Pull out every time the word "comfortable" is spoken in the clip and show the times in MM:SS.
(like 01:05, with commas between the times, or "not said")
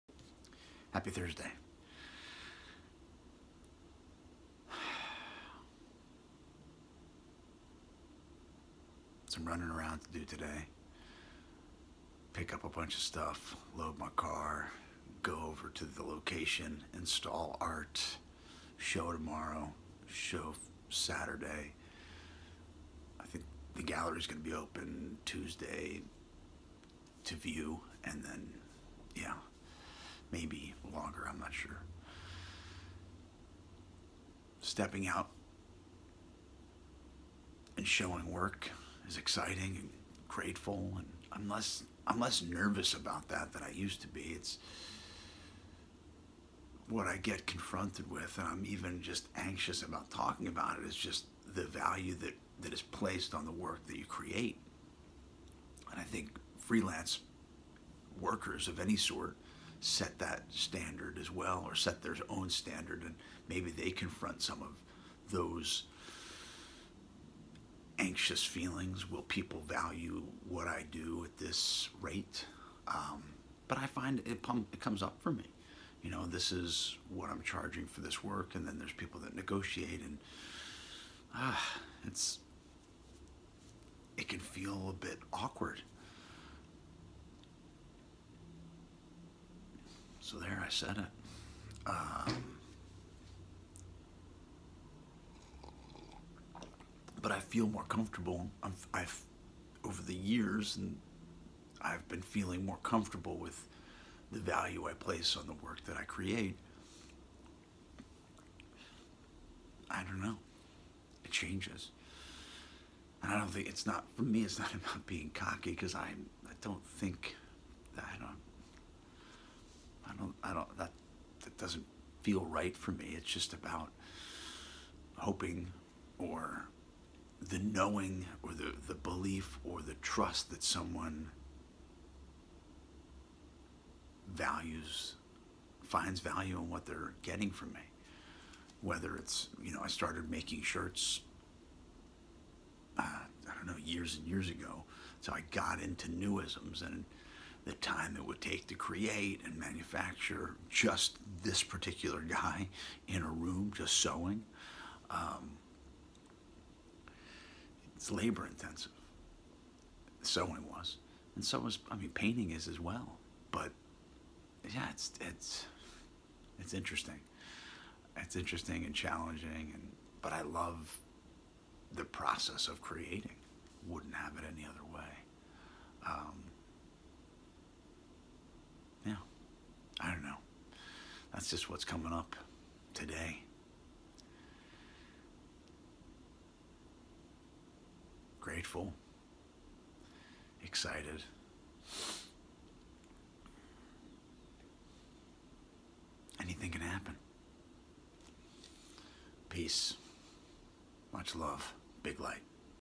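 01:37, 01:42.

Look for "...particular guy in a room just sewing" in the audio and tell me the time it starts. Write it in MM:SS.
02:31.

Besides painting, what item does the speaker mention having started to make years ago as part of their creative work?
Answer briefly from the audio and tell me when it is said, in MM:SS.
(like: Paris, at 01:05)
Shirts, at 02:20.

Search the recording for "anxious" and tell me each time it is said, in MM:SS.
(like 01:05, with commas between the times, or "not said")
00:49, 01:07.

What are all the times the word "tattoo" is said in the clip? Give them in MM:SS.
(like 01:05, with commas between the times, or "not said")
not said.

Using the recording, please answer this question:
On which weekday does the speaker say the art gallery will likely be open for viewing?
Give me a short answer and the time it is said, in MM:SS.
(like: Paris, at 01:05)
Tuesday, at 00:25.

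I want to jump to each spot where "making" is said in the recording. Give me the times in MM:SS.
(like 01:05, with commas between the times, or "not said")
02:20.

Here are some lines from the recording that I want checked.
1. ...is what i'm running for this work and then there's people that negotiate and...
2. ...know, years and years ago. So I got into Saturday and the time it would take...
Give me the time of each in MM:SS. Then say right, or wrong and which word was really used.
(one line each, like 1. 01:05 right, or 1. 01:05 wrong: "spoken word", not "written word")
1. 01:16 wrong: "charging", not "running"
2. 02:23 wrong: "NuISMS", not "Saturday".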